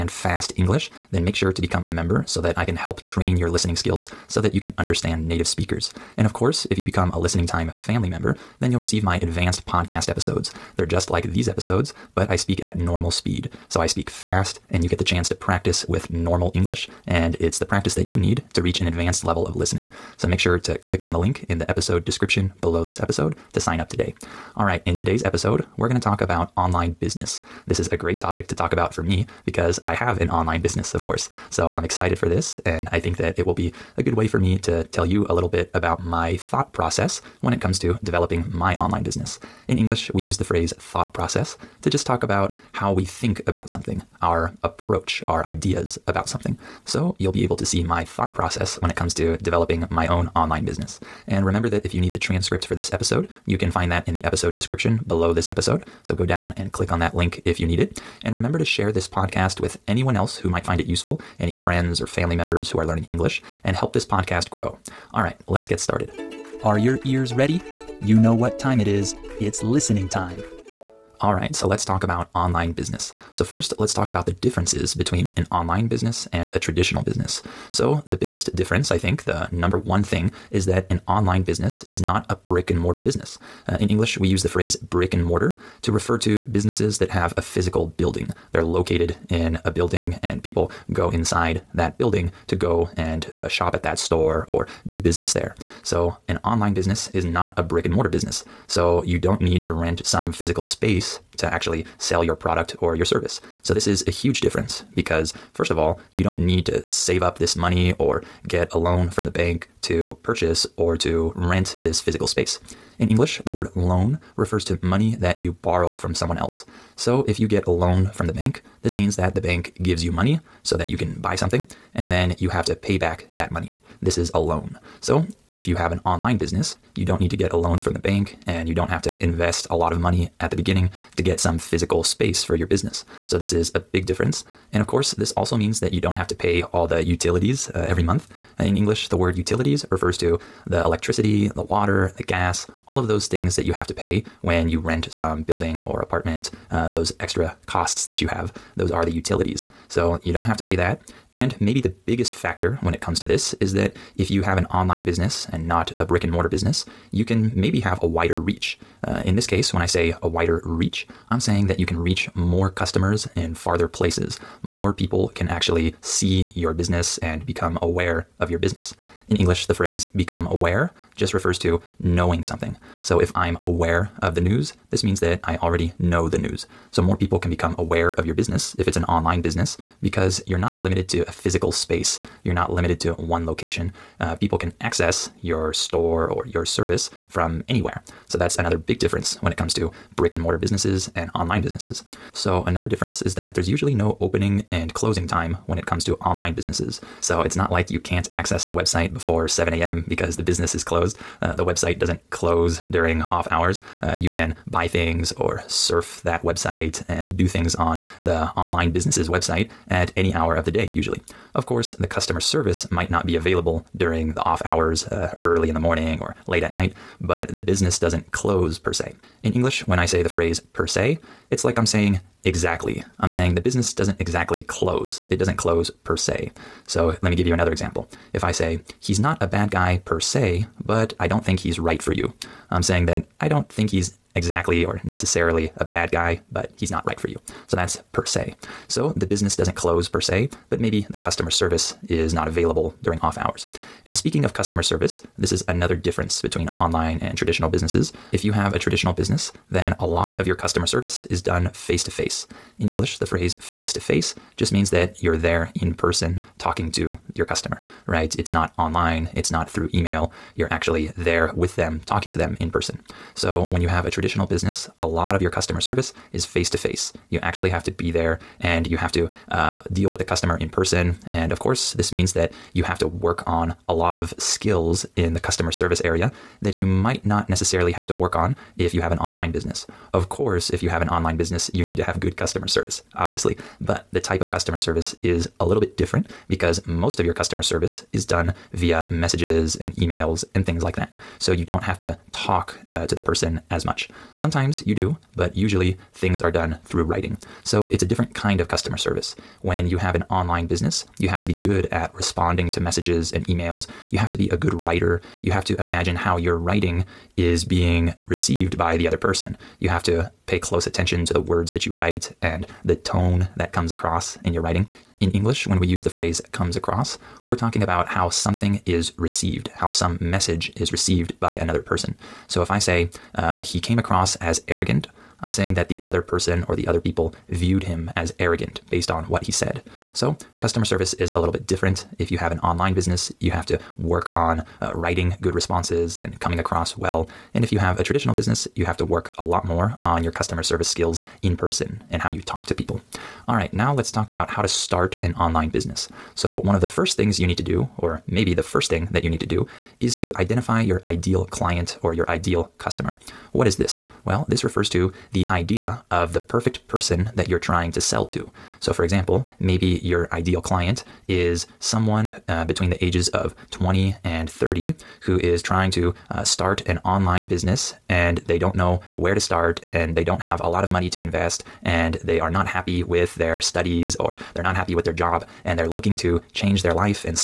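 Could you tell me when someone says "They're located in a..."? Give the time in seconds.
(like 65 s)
88 s.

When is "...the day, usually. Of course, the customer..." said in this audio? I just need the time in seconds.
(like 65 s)
210 s.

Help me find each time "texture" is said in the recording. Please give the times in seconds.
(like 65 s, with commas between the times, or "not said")
not said.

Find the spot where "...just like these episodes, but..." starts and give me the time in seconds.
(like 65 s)
10 s.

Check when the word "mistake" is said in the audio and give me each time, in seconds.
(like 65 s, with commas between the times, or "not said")
not said.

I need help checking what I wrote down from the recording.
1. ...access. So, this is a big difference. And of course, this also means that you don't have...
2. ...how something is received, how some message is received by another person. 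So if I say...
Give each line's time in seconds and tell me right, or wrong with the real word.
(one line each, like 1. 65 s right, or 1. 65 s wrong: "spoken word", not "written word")
1. 132 s wrong: "business", not "access"
2. 318 s right.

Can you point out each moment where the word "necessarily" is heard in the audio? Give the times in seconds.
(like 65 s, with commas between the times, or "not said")
235 s, 277 s.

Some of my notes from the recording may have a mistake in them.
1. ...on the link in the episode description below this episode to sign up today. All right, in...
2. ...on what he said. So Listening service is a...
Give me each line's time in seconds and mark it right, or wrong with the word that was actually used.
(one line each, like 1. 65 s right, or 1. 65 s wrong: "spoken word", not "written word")
1. 21 s right
2. 329 s wrong: "Customer", not "Listening".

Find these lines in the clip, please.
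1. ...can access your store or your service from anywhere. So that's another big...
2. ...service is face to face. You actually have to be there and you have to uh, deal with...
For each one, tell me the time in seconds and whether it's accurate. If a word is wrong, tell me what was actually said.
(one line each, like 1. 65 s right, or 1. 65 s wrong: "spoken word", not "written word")
1. 184 s right
2. 265 s right.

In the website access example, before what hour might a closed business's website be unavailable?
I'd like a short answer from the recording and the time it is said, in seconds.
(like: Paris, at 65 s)
7 a.m., at 199 s.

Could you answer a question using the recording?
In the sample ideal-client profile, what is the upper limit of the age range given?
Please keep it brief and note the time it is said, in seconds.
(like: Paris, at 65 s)
30, at 364 s.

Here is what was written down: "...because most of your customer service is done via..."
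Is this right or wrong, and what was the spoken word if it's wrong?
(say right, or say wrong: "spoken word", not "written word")
right.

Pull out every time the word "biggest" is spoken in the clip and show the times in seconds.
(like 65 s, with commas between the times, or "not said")
78 s, 152 s.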